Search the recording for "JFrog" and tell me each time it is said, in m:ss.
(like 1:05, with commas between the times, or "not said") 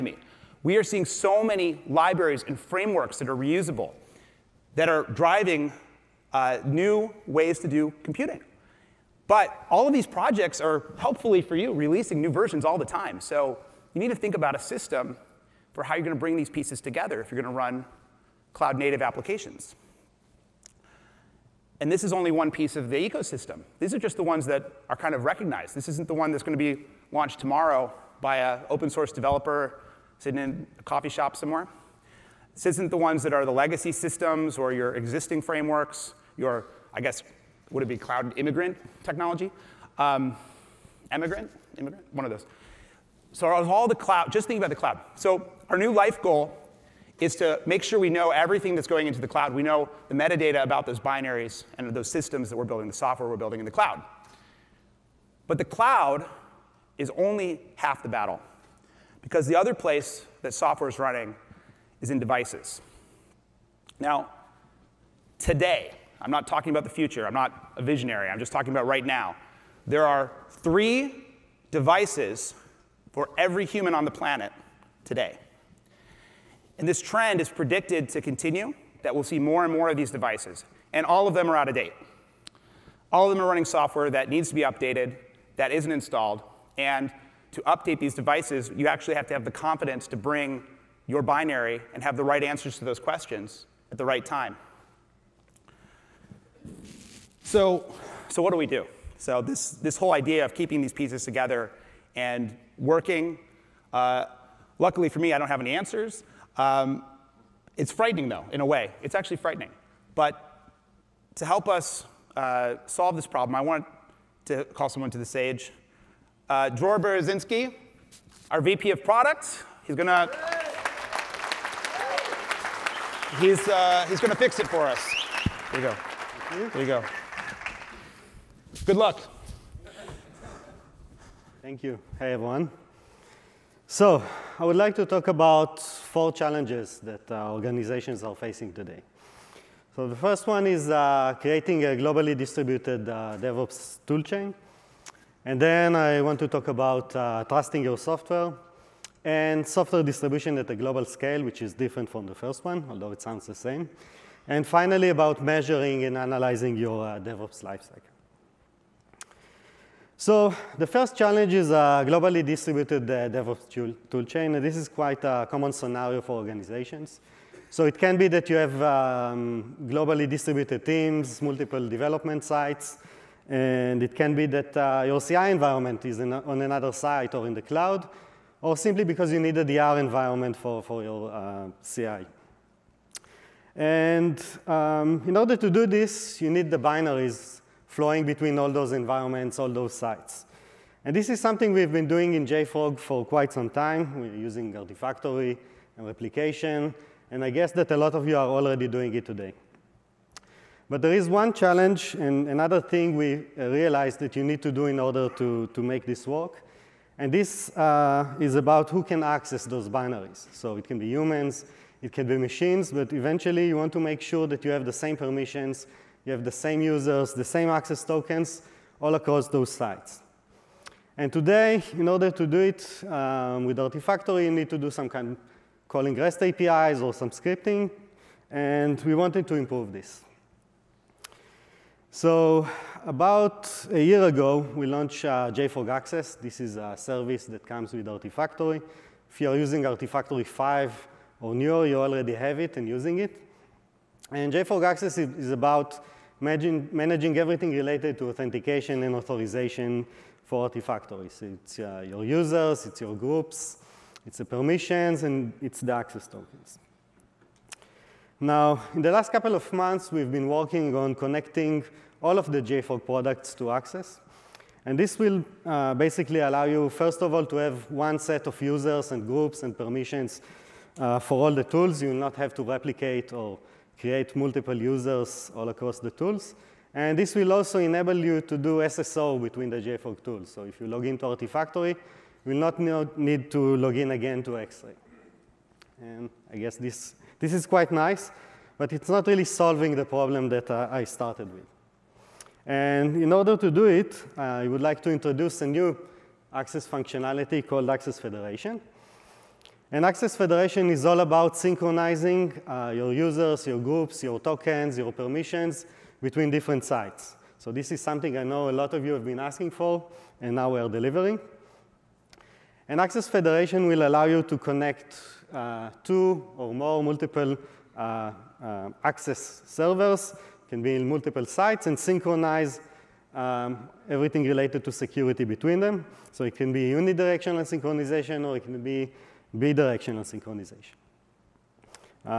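3:12, 3:55, 4:04, 4:22, 4:39.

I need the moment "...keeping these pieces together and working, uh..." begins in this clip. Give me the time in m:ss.
1:40.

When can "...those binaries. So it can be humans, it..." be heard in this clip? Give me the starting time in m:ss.
3:29.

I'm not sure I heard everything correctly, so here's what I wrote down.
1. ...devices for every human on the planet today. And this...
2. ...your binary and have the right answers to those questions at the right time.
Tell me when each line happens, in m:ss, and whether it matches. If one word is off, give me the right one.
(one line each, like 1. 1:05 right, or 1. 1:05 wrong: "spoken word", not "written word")
1. 1:11 right
2. 1:31 right.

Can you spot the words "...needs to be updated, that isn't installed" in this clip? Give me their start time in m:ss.
1:24.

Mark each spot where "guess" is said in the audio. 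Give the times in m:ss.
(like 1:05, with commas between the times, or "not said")
0:36, 3:17, 4:46.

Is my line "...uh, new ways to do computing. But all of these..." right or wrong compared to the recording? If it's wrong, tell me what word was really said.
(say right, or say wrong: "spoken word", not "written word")
right.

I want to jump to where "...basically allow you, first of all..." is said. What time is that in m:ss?
4:25.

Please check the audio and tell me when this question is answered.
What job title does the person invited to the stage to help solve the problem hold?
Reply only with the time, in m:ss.
1:58.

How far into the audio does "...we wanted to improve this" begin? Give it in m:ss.
3:49.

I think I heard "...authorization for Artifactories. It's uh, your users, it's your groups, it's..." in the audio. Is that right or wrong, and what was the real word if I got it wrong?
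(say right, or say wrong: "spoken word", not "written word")
right.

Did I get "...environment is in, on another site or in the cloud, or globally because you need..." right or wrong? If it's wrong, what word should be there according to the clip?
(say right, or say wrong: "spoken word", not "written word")
wrong: "simply", not "globally".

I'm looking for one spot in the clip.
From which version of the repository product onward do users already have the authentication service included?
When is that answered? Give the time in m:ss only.
3:59.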